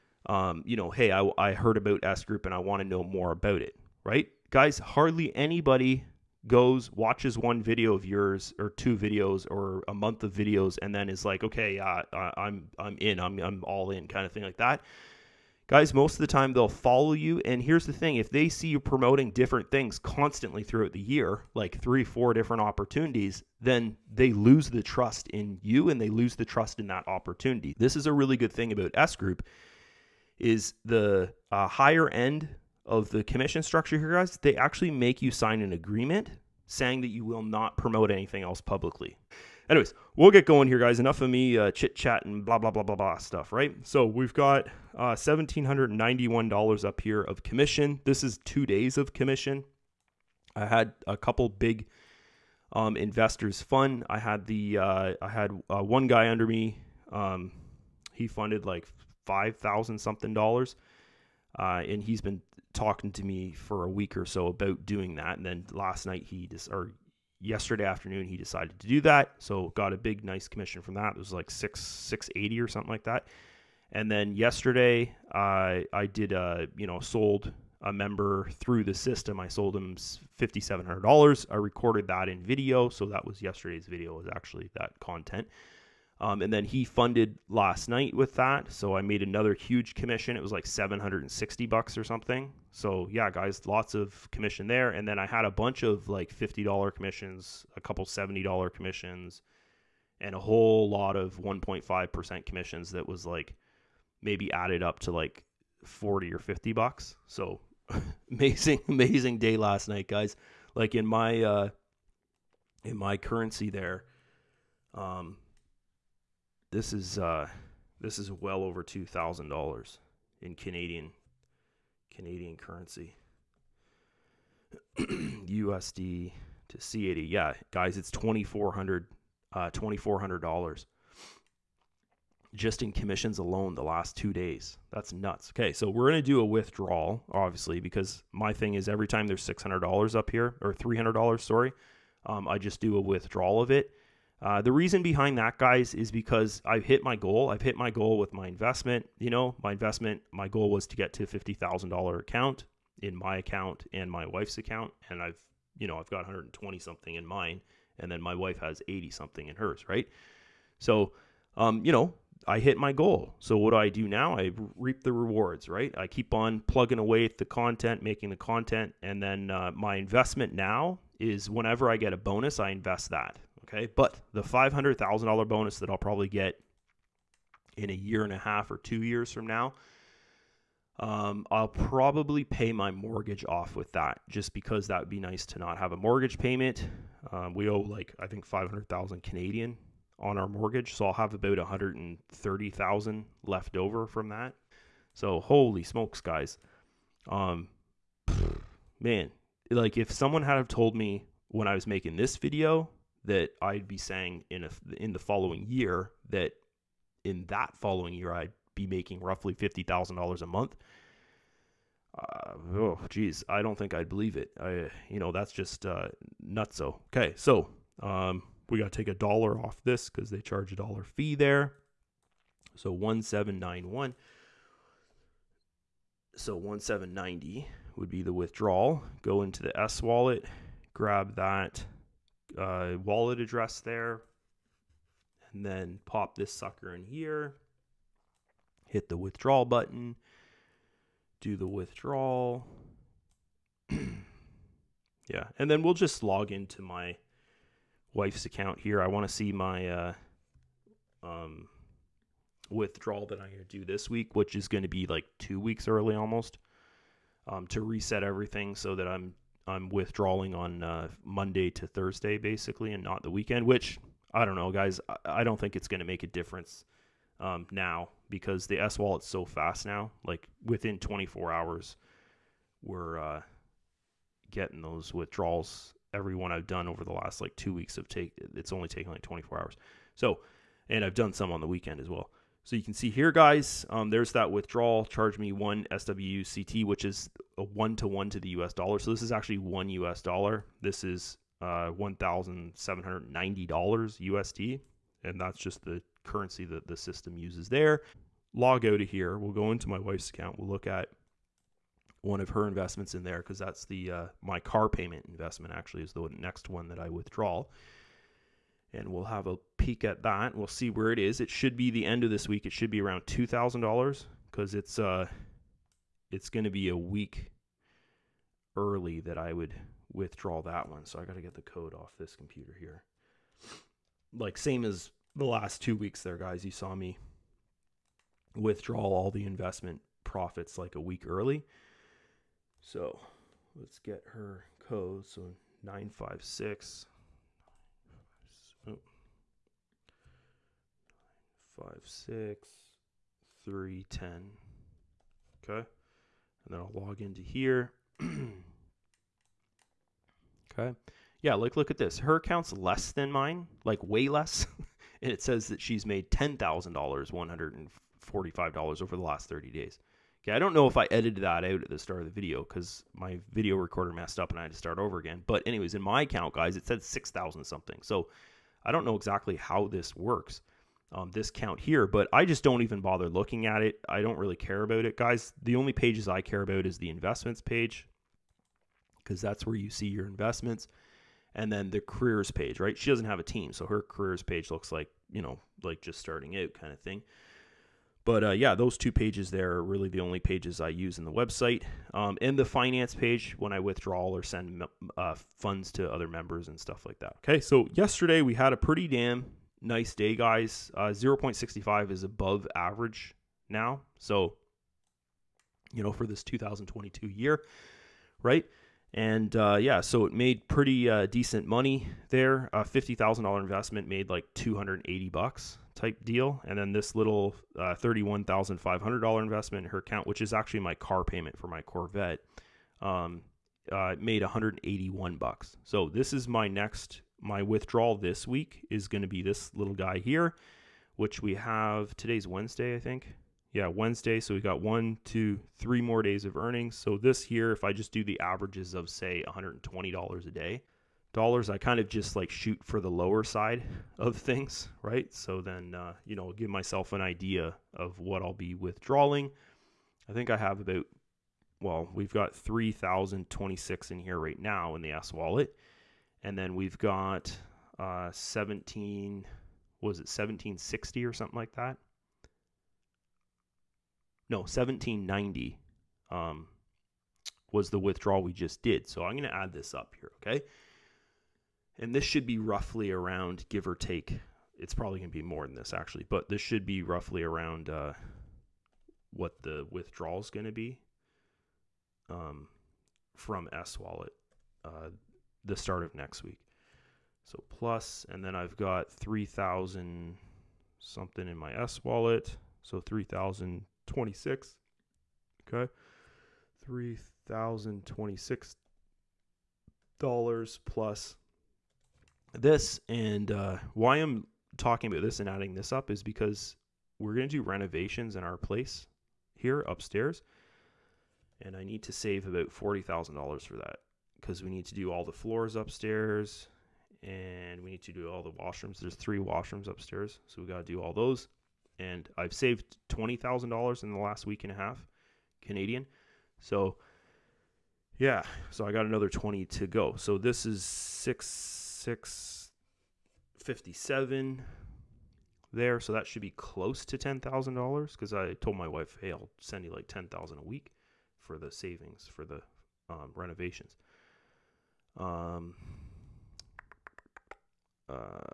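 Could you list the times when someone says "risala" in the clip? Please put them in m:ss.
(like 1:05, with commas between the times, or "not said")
not said.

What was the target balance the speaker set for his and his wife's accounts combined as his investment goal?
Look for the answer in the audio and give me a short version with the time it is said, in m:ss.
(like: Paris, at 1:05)
$50,000, at 2:31.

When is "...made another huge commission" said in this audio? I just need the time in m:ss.
1:28.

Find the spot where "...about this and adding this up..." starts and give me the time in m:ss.
8:25.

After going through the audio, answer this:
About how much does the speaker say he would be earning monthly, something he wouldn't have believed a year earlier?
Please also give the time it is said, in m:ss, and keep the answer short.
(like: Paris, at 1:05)
$50,000, at 3:29.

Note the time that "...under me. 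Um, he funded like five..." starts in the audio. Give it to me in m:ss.
0:56.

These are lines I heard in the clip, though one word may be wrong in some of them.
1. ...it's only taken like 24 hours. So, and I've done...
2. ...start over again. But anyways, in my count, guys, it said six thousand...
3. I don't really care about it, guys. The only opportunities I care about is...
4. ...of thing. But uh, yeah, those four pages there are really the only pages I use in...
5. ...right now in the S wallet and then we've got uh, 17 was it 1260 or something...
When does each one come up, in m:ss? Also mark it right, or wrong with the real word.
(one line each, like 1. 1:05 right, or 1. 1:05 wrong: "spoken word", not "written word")
1. 4:38 right
2. 6:04 wrong: "account", not "count"
3. 6:14 wrong: "pages", not "opportunities"
4. 6:26 wrong: "two", not "four"
5. 7:34 wrong: "1760", not "1260".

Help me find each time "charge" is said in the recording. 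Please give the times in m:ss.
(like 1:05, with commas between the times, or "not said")
3:40, 4:45.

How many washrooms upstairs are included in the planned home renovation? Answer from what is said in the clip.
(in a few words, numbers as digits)
3.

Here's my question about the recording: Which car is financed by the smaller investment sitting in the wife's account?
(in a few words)
Corvette.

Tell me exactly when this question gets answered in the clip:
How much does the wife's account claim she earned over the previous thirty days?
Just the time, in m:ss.
5:56.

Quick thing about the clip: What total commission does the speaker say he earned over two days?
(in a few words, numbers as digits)
$1,791.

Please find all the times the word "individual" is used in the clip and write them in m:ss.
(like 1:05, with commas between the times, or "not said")
not said.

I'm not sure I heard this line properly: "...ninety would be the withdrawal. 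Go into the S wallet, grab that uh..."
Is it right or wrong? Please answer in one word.
right.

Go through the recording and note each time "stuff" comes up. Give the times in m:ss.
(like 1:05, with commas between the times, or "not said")
0:43, 6:36.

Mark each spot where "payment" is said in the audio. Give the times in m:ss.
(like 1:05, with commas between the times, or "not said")
3:06, 5:04, 7:01.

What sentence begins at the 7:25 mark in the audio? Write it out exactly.
So then, uh, you know, give myself an idea of what I'll be withdrawing.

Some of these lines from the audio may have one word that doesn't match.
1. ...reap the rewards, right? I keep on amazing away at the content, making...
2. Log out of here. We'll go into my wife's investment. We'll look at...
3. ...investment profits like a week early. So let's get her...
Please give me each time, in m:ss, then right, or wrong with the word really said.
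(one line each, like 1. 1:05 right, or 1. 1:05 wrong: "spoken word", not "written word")
1. 2:44 wrong: "plugging", not "amazing"
2. 4:58 wrong: "account", not "investment"
3. 5:29 right.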